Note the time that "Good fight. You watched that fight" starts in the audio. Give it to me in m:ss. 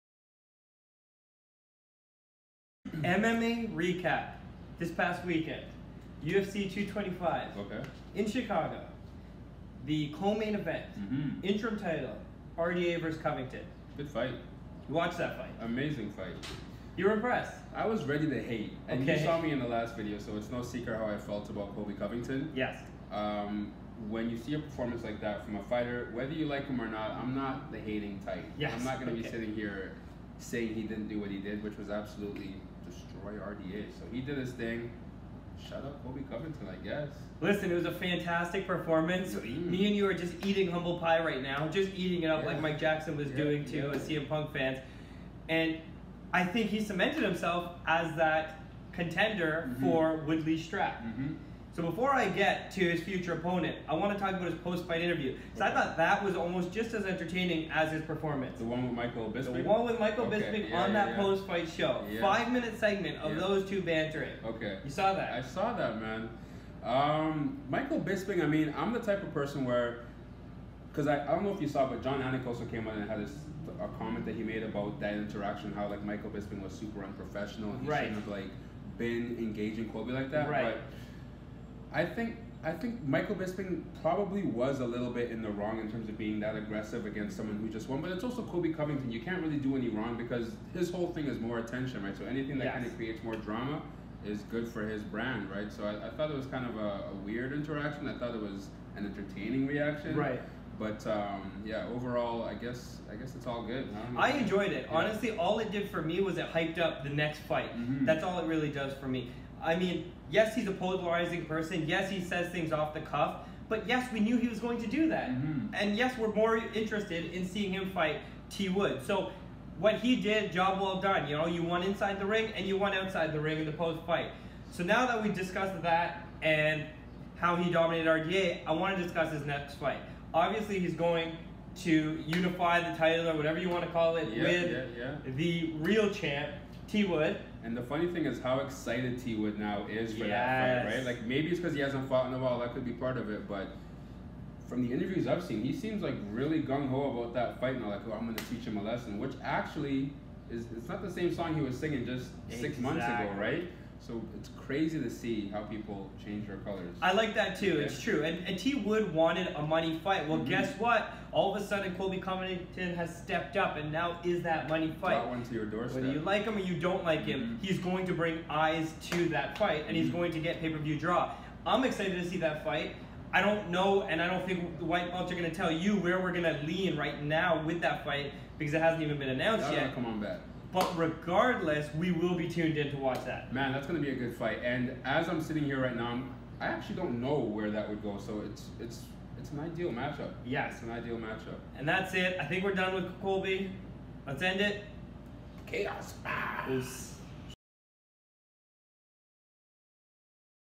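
0:13.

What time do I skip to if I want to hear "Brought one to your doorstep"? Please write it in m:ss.
2:45.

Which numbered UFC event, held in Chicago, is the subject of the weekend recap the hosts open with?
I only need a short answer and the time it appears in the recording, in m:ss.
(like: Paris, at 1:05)
UFC 225, at 0:06.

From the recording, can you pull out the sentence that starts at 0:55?
So I thought that was almost just as entertaining as his performance.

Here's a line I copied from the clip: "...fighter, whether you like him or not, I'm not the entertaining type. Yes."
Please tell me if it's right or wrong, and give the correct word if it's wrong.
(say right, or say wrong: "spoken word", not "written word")
wrong: "hating", not "entertaining".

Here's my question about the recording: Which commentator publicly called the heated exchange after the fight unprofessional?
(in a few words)
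Jon Anik.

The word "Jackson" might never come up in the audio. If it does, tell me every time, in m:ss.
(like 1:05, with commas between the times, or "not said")
0:42.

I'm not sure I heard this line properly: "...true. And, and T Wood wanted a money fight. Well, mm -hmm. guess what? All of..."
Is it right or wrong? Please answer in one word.
right.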